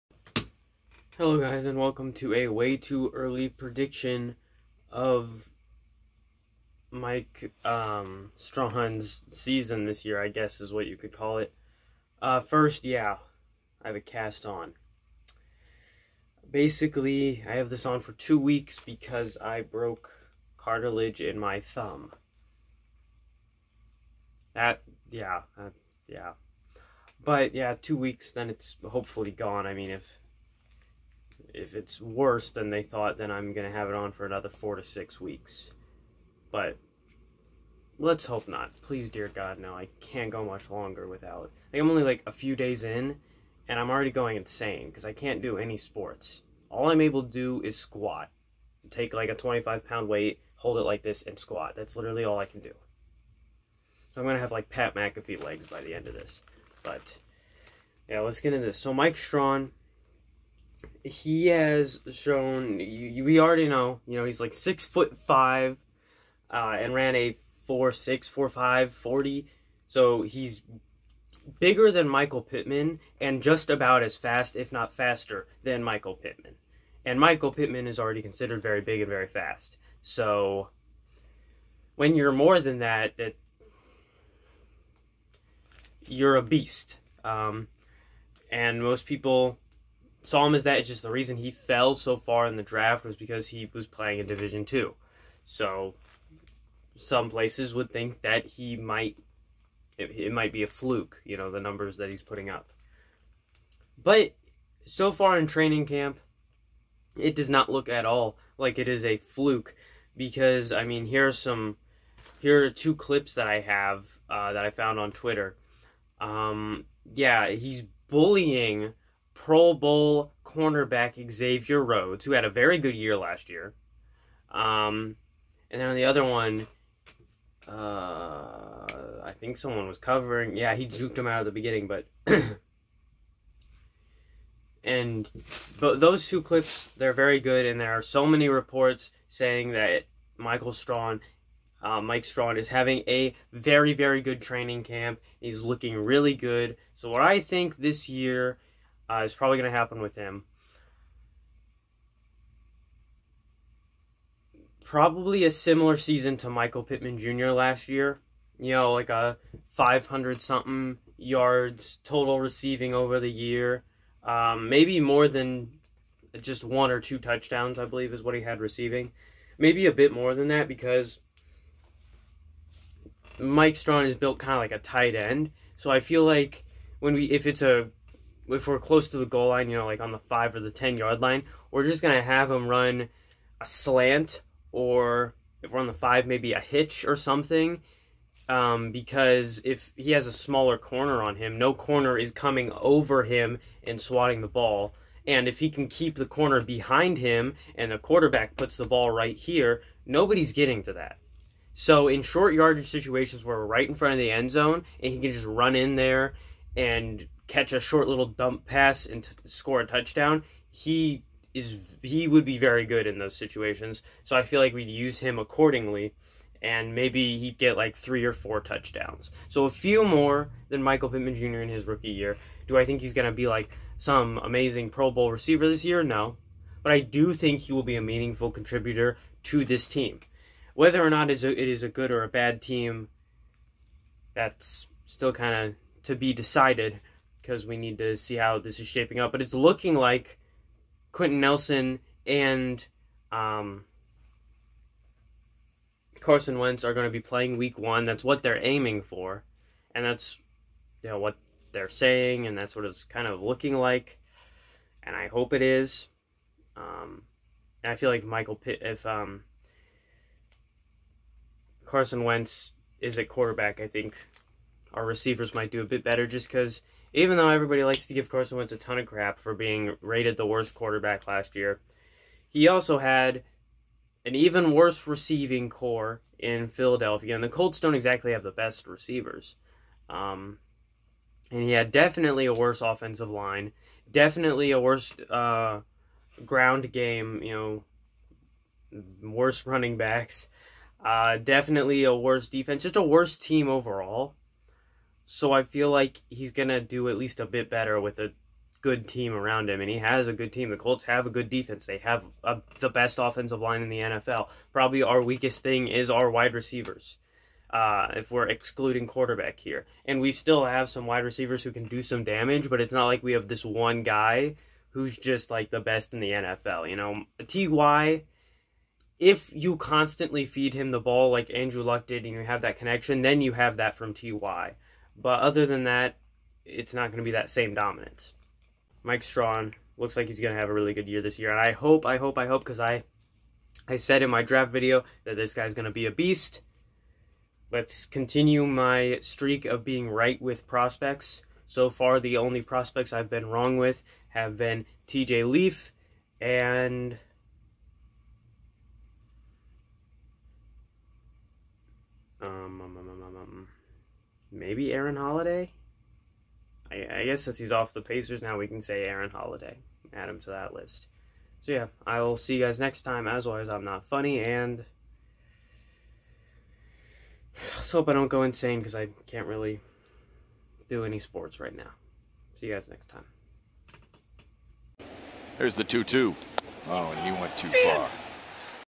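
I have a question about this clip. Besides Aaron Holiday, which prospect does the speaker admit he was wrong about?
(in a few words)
TJ Leaf.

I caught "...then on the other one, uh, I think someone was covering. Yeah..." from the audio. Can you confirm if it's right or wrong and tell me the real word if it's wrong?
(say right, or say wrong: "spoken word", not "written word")
right.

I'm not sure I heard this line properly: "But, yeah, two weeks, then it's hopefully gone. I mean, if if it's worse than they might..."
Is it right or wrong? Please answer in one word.
wrong.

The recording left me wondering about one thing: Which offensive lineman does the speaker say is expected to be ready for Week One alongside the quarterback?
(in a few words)
Quenton Nelson.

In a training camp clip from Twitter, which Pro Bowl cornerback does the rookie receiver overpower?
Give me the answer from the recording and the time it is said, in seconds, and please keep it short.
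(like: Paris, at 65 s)
Xavier Rhodes, at 121 s.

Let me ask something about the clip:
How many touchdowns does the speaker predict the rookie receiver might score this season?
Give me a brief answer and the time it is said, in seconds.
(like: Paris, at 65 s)
3 or 4, at 217 s.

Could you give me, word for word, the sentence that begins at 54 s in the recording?
So I'm going to have like Pat McAfee legs by the end of this.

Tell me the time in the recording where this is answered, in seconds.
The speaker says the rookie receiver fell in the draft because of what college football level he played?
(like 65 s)
94 s.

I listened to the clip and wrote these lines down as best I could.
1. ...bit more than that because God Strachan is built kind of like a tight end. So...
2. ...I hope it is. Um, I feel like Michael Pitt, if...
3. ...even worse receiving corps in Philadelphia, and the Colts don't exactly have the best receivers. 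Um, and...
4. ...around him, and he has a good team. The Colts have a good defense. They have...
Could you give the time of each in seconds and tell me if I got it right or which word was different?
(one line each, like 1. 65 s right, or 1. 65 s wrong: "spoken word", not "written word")
1. 169 s wrong: "Mike", not "God"
2. 255 s right
3. 274 s right
4. 299 s right.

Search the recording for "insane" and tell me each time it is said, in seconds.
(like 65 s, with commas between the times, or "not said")
44 s, 368 s.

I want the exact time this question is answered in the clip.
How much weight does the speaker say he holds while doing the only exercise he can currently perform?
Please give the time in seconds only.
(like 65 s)
49 s.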